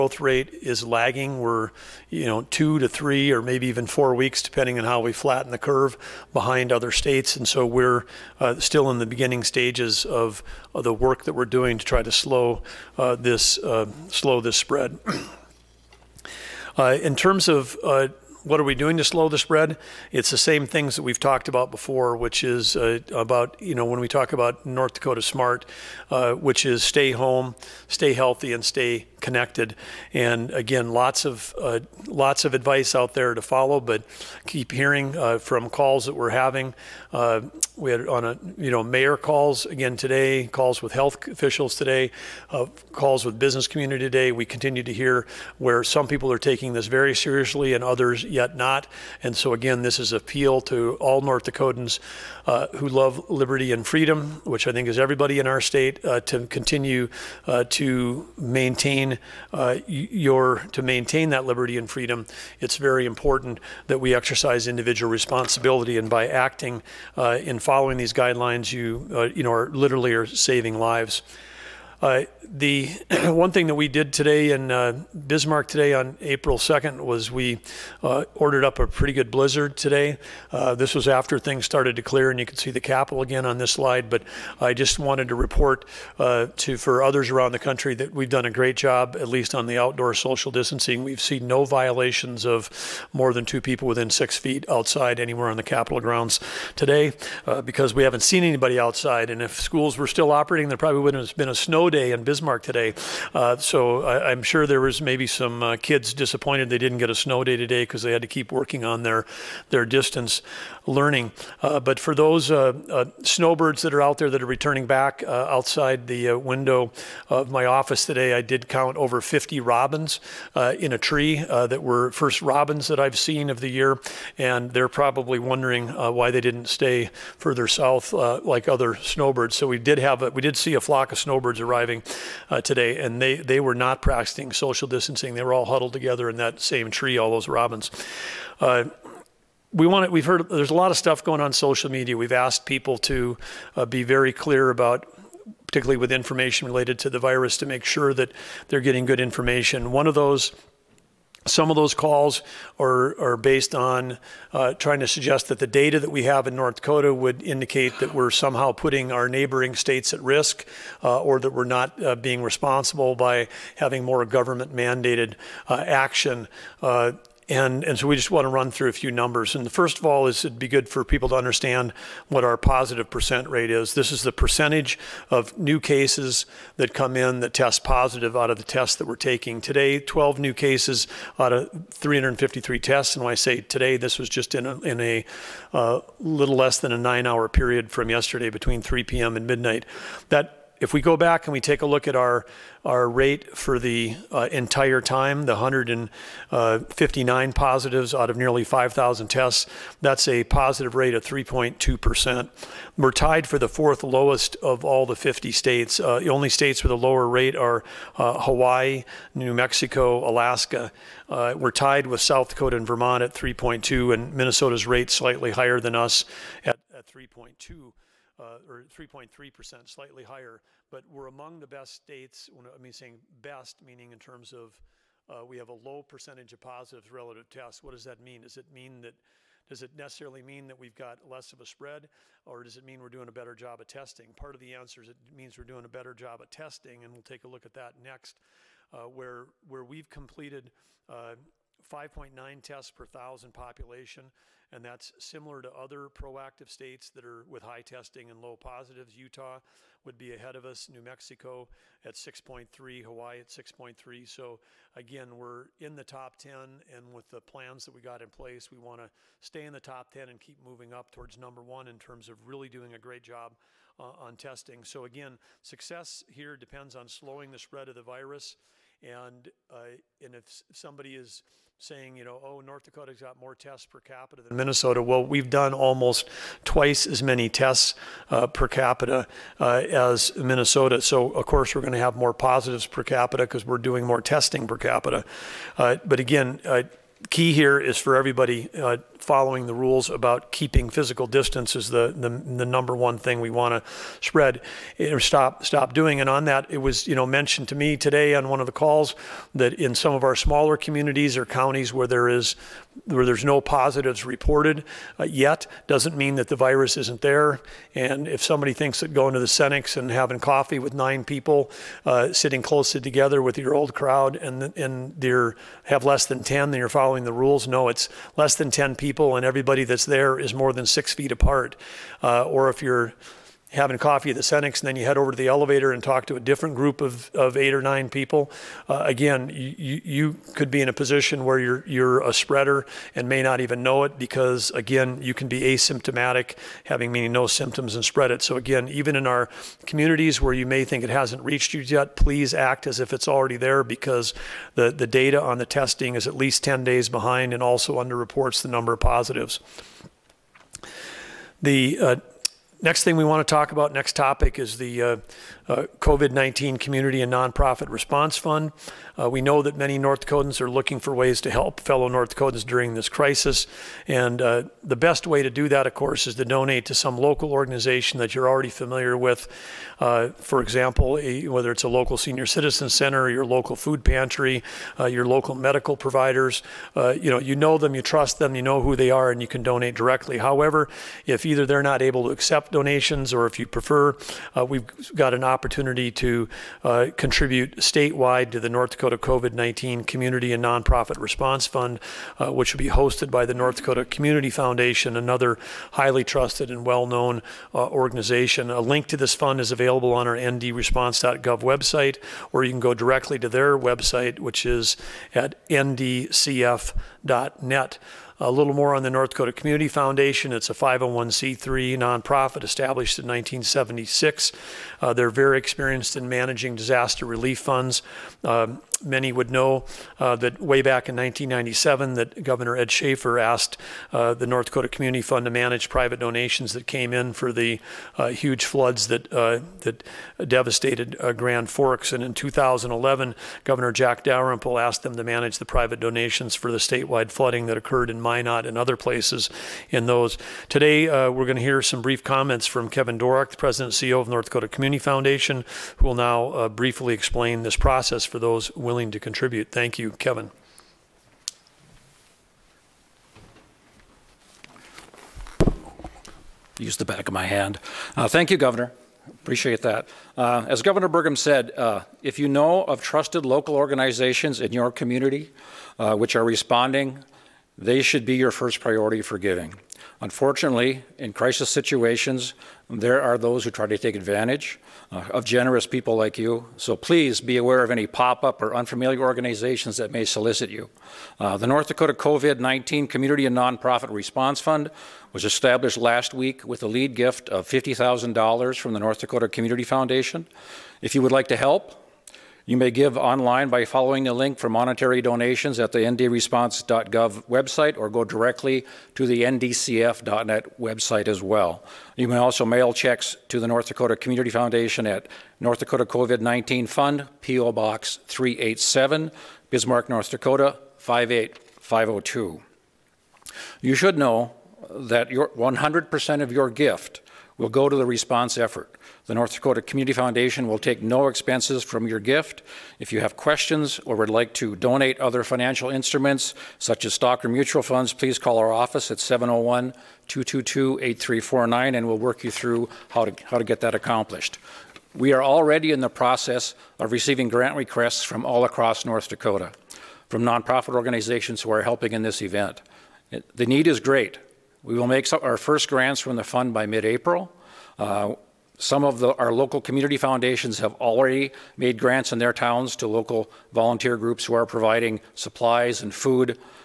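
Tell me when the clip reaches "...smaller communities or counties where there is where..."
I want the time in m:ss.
5:00.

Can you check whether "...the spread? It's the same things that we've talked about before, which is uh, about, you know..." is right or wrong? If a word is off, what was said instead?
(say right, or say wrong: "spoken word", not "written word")
right.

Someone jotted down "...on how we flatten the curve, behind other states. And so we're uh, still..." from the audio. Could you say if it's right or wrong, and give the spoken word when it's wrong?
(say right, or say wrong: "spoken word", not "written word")
right.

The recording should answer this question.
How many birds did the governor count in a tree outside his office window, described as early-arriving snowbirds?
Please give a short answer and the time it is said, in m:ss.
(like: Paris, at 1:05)
Over 50, at 1:58.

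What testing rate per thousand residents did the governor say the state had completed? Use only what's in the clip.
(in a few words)
5.9.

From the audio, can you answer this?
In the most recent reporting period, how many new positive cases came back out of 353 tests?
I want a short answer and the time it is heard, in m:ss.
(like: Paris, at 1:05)
12, at 2:59.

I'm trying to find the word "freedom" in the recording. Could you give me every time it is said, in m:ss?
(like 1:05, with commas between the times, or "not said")
0:53, 1:01.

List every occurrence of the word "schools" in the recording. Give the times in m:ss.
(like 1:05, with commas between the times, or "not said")
1:39.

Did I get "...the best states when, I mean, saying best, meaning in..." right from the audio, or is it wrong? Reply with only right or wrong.
right.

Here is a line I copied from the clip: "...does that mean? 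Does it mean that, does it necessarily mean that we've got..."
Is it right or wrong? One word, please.
right.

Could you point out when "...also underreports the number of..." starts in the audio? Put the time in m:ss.
5:47.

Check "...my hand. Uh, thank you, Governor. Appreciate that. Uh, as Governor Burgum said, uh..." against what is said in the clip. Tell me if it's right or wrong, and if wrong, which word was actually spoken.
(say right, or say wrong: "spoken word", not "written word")
right.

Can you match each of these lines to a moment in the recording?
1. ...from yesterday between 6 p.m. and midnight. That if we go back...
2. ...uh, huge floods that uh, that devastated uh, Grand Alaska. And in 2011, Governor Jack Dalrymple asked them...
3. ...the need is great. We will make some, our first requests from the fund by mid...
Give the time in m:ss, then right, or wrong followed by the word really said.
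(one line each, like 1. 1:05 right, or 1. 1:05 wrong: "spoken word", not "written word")
1. 3:07 wrong: "3", not "6"
2. 7:08 wrong: "Forks", not "Alaska"
3. 9:03 wrong: "grants", not "requests".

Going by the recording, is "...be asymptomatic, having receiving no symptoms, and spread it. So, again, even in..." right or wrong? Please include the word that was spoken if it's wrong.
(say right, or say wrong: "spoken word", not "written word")
wrong: "meaning", not "receiving".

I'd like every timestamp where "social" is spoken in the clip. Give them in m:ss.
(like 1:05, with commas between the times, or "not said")
1:30, 2:14, 2:21.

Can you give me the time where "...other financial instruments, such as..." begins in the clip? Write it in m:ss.
8:45.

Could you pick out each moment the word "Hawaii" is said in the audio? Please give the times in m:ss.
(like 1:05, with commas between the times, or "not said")
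3:28, 4:13.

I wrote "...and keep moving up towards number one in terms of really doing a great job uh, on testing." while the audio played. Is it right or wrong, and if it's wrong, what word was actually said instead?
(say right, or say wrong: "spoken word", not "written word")
right.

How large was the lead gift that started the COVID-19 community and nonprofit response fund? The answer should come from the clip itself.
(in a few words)
$50,000.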